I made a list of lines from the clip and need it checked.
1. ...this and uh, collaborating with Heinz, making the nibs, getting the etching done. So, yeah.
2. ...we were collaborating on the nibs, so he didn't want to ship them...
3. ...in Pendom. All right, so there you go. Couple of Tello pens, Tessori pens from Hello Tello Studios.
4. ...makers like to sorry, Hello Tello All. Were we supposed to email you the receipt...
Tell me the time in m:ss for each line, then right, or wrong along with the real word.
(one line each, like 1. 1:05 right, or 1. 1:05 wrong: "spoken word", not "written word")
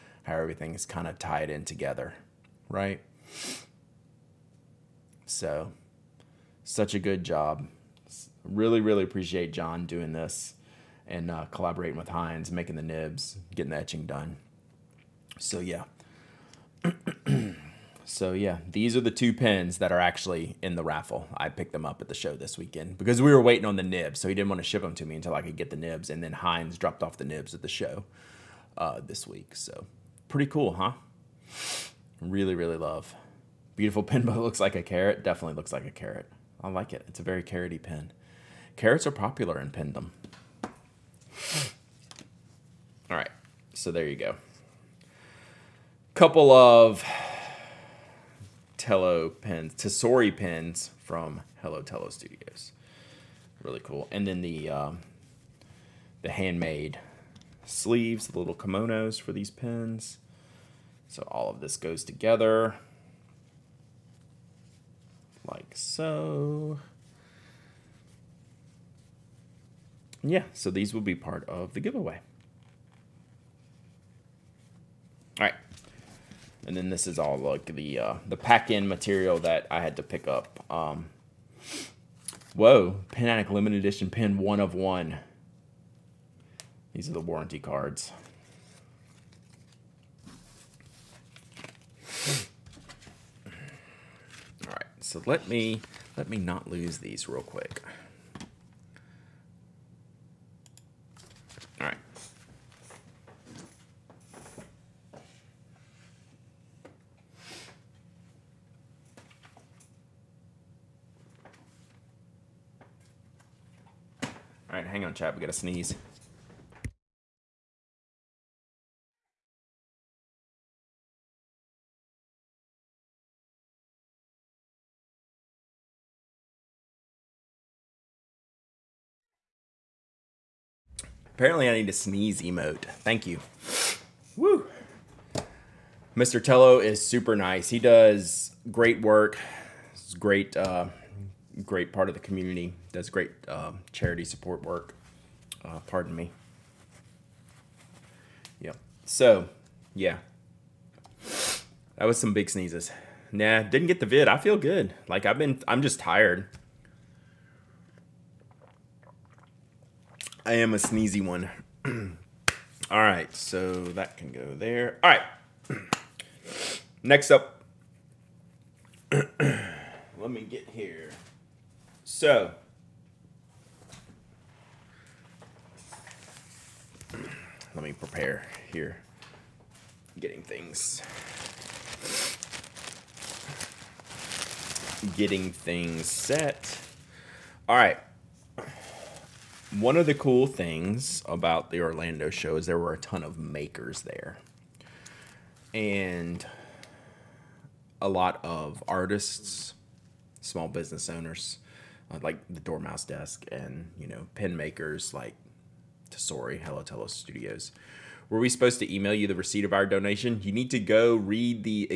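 1. 0:10 right
2. 0:23 wrong: "waiting", not "collaborating"
3. 0:39 right
4. 3:24 wrong: "Studios", not "All".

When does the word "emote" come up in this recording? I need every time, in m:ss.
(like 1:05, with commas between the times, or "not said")
2:12.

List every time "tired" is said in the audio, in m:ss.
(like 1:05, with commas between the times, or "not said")
2:35.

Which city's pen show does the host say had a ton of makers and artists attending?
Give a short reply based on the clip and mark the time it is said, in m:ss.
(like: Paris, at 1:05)
Orlando, at 3:11.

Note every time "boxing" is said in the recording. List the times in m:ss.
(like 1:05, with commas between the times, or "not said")
not said.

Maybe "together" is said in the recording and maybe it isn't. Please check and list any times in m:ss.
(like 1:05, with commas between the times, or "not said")
0:01, 1:02.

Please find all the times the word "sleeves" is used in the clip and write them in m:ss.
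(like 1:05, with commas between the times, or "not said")
0:57.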